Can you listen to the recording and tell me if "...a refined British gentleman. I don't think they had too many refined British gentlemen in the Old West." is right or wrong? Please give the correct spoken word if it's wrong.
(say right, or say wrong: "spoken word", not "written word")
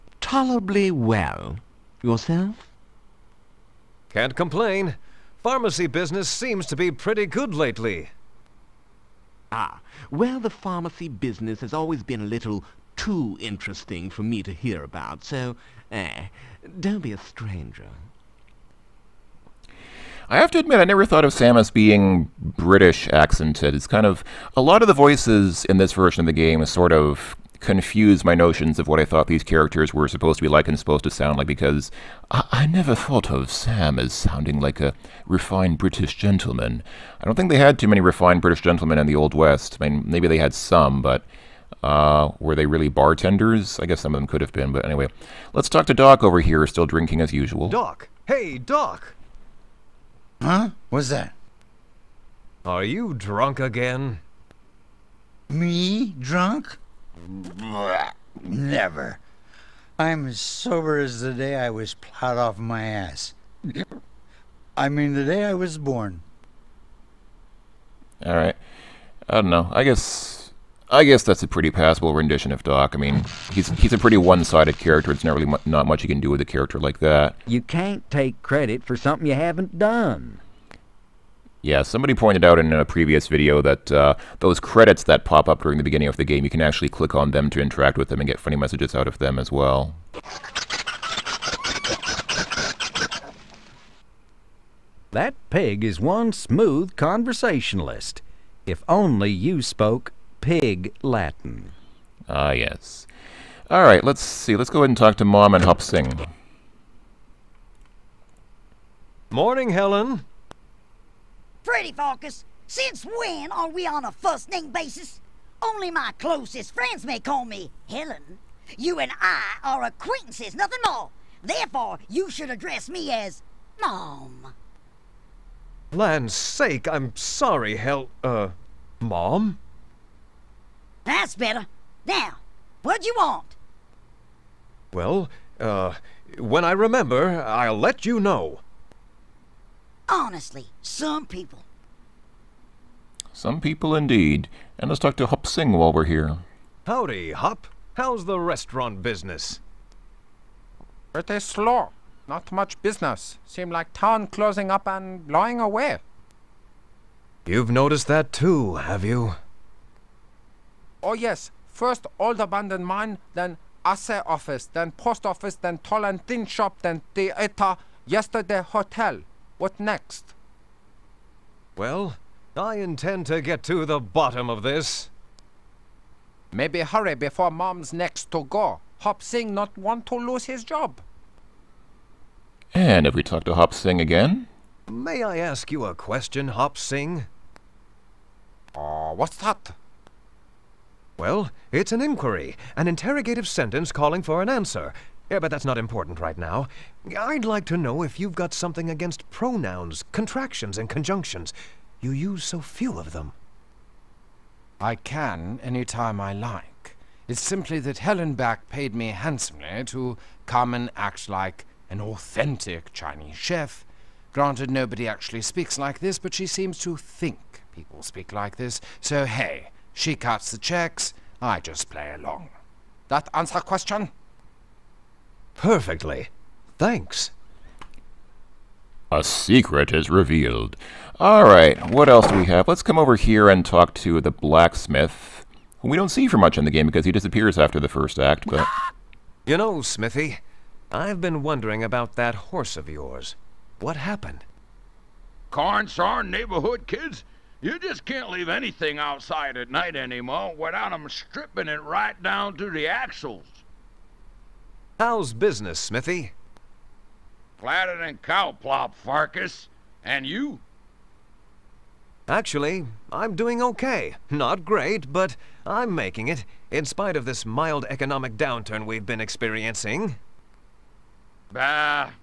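right.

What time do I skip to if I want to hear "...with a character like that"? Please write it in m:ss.
1:16.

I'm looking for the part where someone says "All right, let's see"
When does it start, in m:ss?
1:43.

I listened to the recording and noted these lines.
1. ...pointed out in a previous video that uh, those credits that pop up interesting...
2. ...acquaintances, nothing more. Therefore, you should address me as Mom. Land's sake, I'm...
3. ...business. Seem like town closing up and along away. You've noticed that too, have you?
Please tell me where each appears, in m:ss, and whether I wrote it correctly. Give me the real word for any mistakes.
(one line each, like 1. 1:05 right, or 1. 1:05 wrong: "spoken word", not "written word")
1. 1:22 wrong: "during", not "interesting"
2. 1:59 right
3. 2:32 wrong: "blowing", not "along".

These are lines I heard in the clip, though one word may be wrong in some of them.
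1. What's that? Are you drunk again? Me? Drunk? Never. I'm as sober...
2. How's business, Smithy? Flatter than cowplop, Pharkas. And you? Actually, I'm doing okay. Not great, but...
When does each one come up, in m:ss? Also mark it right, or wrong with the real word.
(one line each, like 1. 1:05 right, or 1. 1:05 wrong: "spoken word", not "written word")
1. 0:50 right
2. 4:14 right.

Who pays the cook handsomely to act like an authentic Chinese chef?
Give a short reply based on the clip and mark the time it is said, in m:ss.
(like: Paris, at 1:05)
Helen Back, at 3:27.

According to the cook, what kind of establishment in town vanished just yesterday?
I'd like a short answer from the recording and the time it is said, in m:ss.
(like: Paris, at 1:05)
Hotel, at 2:48.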